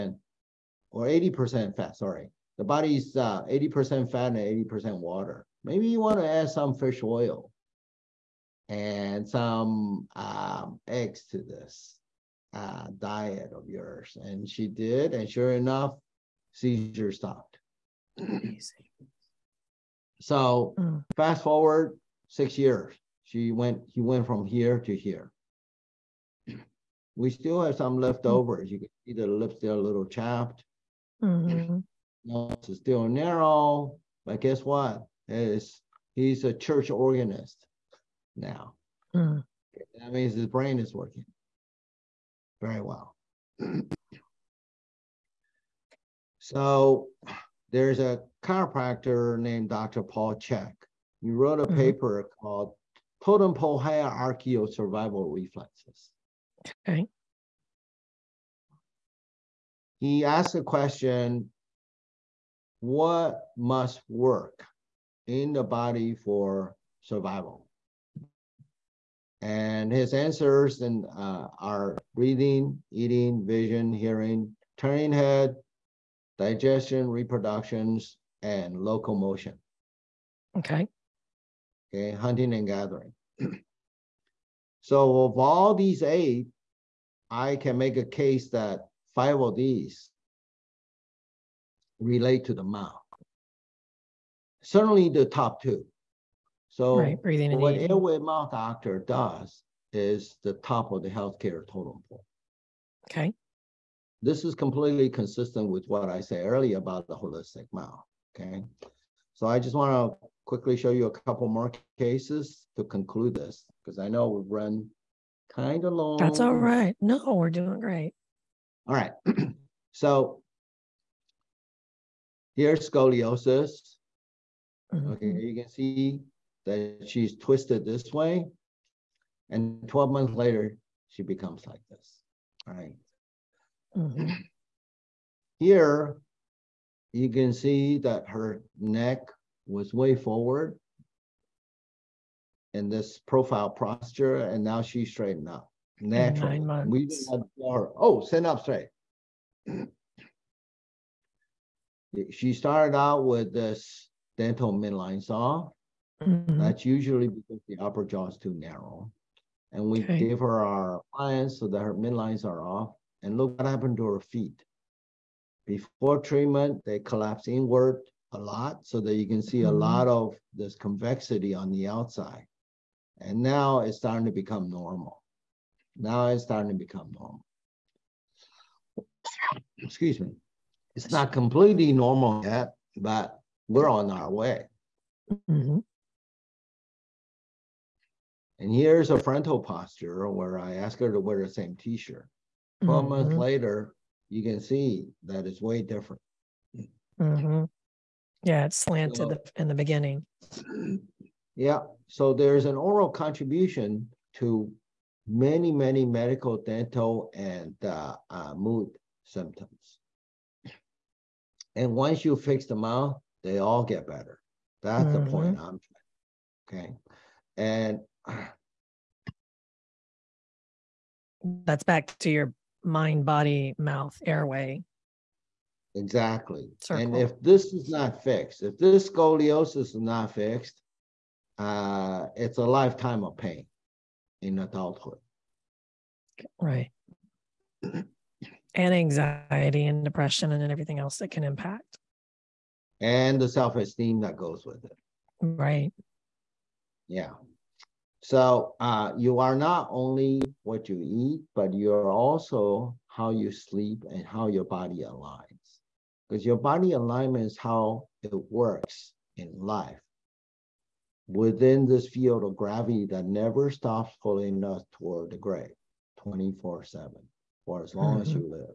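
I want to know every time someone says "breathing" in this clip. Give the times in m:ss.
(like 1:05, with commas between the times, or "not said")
1:12, 1:37.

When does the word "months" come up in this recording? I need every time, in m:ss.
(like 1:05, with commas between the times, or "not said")
2:10, 2:26, 3:13.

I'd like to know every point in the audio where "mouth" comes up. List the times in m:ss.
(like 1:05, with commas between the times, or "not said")
1:32, 1:38, 1:47, 3:43.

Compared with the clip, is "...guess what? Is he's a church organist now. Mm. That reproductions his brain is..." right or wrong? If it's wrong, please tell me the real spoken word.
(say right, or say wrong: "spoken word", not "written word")
wrong: "means", not "reproductions".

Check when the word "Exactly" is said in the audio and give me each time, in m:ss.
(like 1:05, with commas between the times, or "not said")
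3:45.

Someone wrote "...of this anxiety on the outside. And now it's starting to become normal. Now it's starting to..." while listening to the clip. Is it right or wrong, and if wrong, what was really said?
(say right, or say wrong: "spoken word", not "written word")
wrong: "convexity", not "anxiety".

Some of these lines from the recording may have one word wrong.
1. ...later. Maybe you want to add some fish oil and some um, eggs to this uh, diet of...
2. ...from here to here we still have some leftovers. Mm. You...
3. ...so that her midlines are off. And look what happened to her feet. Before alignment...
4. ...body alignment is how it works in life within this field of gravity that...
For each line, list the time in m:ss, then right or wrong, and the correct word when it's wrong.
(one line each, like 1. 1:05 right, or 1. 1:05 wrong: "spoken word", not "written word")
1. 0:04 wrong: "water", not "later"
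2. 0:24 right
3. 2:41 wrong: "treatment", not "alignment"
4. 4:16 right.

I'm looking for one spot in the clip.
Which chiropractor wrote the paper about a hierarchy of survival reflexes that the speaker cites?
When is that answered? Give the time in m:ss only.
0:49.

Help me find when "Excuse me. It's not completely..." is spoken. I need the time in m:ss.
2:59.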